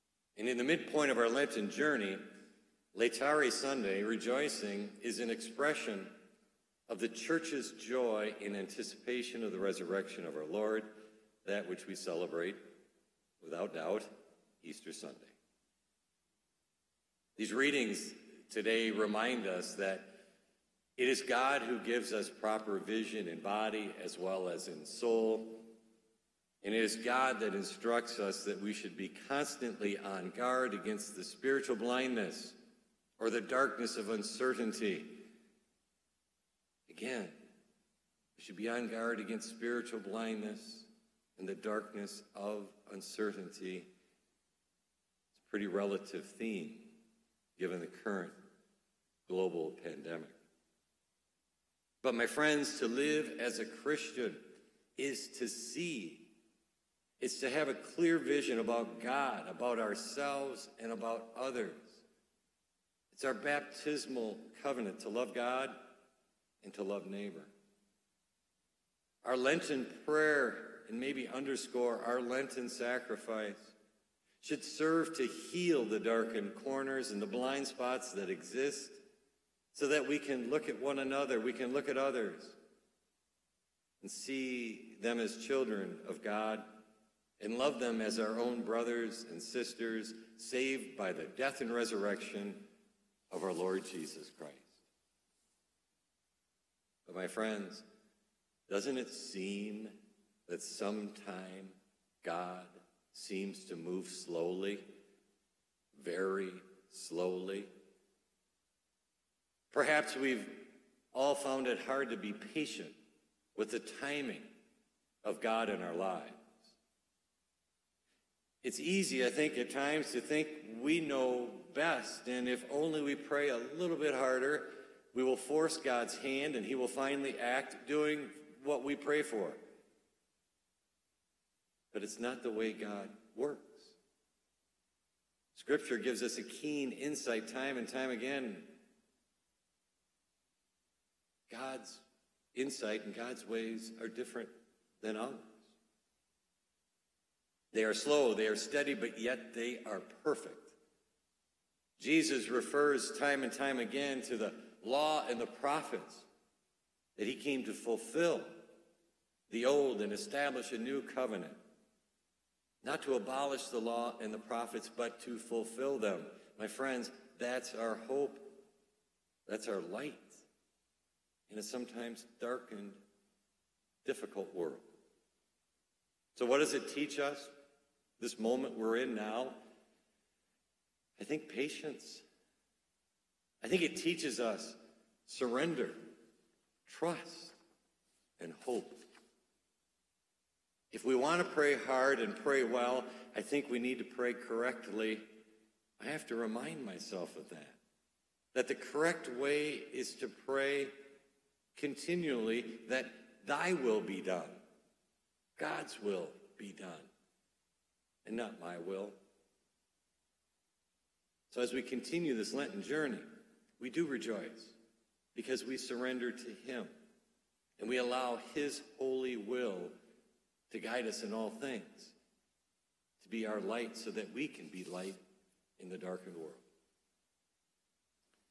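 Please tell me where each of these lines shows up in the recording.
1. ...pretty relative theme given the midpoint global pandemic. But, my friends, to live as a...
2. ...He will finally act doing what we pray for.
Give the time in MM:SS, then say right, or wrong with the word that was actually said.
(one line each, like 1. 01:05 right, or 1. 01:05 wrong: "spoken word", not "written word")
1. 00:45 wrong: "current", not "midpoint"
2. 02:06 right.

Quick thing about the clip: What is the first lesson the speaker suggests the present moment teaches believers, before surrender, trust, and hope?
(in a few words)
patience.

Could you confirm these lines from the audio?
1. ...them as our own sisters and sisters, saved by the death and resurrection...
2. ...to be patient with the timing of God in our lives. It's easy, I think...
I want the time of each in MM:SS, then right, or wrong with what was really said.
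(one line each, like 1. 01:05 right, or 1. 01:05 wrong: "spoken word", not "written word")
1. 01:27 wrong: "brothers", not "sisters"
2. 01:52 right.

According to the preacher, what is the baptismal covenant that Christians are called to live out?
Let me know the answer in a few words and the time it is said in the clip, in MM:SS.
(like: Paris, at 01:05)
to love God and to love neighbor, at 01:04.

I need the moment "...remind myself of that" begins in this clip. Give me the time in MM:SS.
03:16.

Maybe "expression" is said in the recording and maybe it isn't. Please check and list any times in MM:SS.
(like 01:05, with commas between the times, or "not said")
00:05.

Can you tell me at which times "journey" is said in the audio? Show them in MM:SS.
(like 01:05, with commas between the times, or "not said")
00:01, 03:32.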